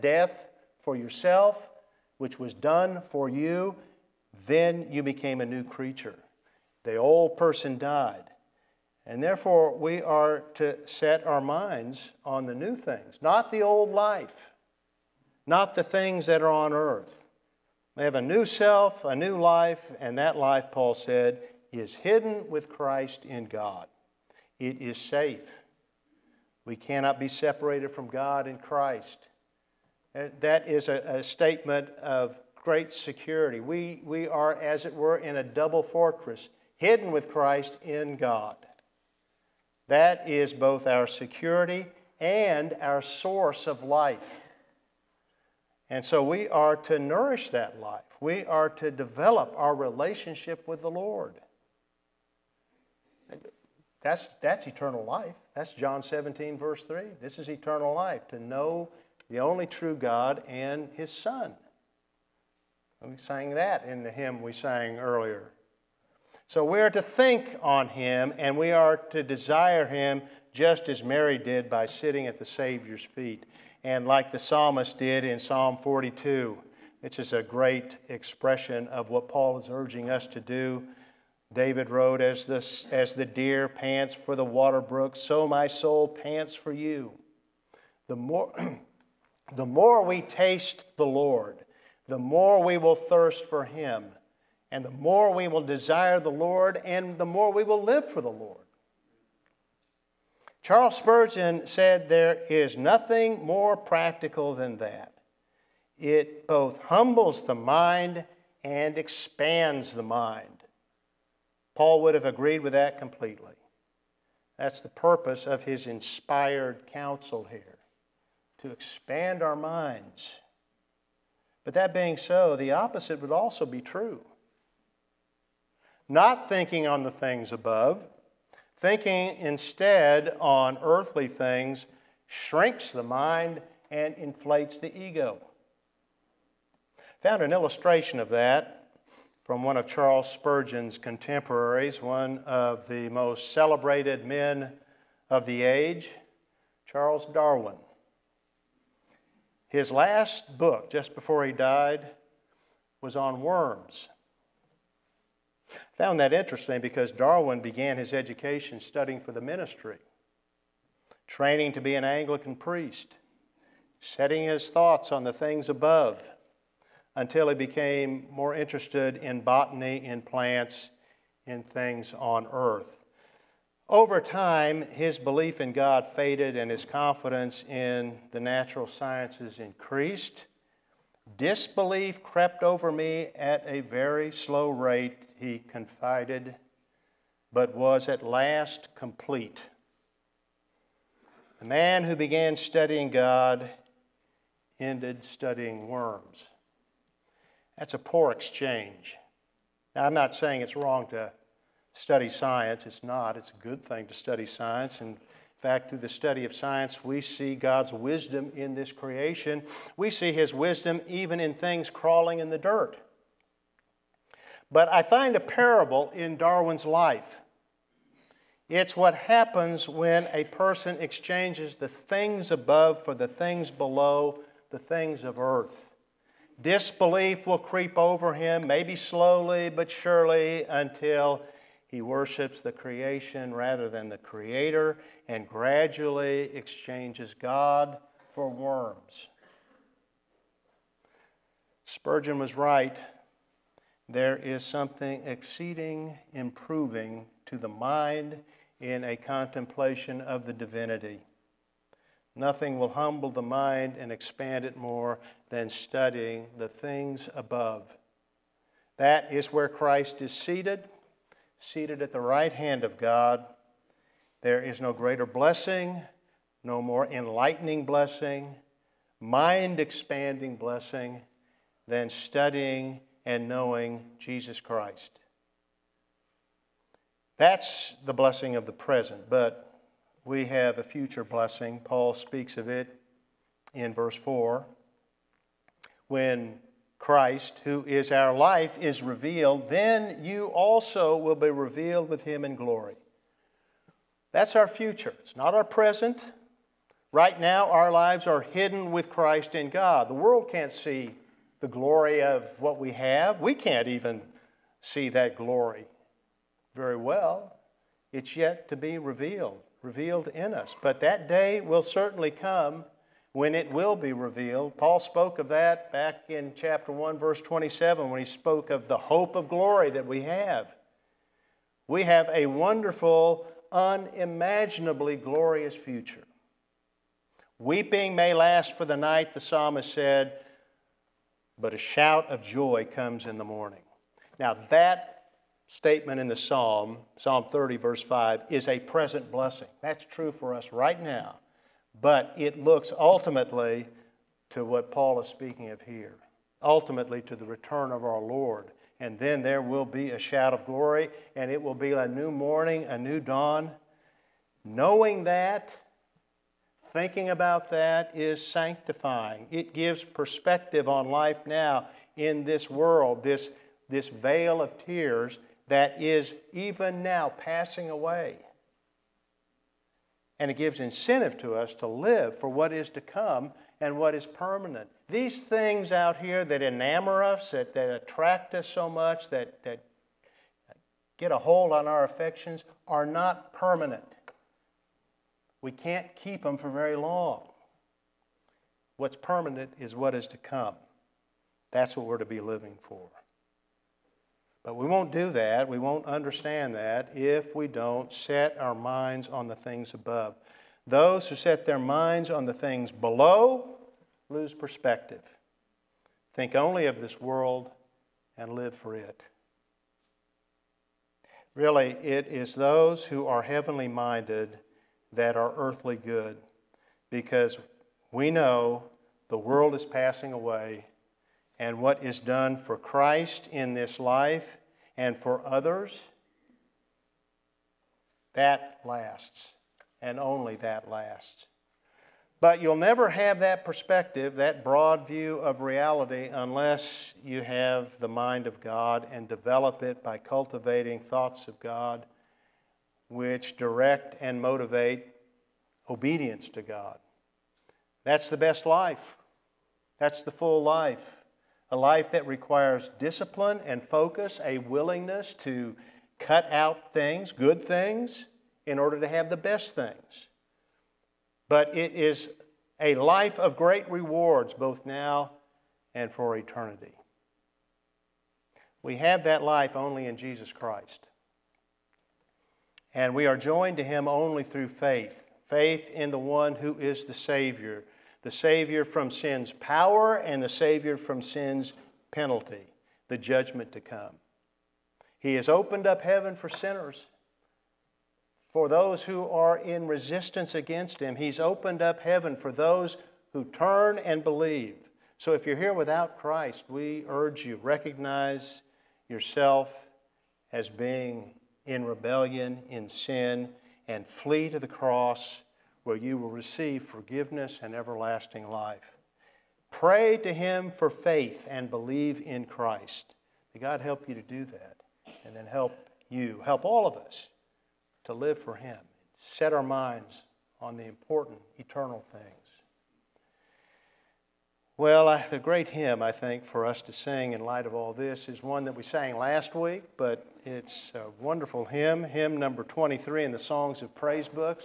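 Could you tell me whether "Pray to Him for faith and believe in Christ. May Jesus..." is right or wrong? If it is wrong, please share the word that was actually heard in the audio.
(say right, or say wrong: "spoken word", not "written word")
wrong: "God", not "Jesus".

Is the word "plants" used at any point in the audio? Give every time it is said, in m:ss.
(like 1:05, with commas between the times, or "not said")
2:50.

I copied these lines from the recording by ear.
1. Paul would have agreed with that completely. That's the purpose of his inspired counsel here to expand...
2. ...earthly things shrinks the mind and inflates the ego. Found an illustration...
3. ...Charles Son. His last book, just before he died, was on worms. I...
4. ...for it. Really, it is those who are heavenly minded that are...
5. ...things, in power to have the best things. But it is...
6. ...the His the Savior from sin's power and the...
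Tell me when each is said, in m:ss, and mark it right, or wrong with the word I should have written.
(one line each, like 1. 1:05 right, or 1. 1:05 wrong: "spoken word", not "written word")
1. 1:51 right
2. 2:10 right
3. 2:26 wrong: "Darwin", not "Son"
4. 6:48 right
5. 7:37 wrong: "order", not "power"
6. 7:57 wrong: "Savior", not "His".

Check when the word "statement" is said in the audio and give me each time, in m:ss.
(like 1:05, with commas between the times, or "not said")
0:31, 5:35.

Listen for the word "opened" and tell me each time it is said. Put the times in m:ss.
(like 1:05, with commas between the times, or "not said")
8:05, 8:11.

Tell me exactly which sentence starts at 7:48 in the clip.
We have that life only in Jesus Christ.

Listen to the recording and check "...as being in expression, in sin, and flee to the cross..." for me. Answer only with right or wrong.
wrong.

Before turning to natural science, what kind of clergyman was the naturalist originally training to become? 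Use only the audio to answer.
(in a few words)
Anglican priest.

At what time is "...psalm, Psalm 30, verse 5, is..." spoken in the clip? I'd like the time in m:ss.
5:36.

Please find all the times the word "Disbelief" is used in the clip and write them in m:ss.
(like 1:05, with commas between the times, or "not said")
3:01, 3:46.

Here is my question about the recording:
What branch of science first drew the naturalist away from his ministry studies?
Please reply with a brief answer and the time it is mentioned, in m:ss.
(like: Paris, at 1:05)
Botany, at 2:49.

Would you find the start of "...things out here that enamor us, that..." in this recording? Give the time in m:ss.
6:15.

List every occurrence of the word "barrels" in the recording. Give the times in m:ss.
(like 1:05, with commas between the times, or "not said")
not said.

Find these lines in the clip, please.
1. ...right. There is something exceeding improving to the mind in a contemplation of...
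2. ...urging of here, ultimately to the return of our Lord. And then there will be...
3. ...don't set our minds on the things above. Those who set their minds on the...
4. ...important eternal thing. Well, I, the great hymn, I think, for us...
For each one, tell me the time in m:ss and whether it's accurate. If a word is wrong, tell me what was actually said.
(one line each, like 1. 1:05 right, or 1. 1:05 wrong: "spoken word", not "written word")
1. 4:02 right
2. 5:45 wrong: "speaking", not "urging"
3. 6:37 right
4. 8:40 right.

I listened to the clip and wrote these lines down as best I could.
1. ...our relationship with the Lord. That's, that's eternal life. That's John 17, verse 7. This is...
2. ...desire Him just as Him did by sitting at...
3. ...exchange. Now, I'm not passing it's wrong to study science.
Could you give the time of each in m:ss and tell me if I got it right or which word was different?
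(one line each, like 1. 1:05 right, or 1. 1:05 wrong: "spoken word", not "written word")
1. 0:49 wrong: "3", not "7"
2. 1:09 wrong: "Mary", not "Him"
3. 3:18 wrong: "saying", not "passing".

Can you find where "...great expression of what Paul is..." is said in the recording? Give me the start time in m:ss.
1:17.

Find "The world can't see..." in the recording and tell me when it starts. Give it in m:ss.
5:00.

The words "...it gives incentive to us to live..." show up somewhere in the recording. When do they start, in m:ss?
6:10.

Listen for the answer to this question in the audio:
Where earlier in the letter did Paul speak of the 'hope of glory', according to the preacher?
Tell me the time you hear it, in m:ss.
5:16.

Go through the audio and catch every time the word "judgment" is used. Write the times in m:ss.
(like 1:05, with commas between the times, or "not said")
8:03.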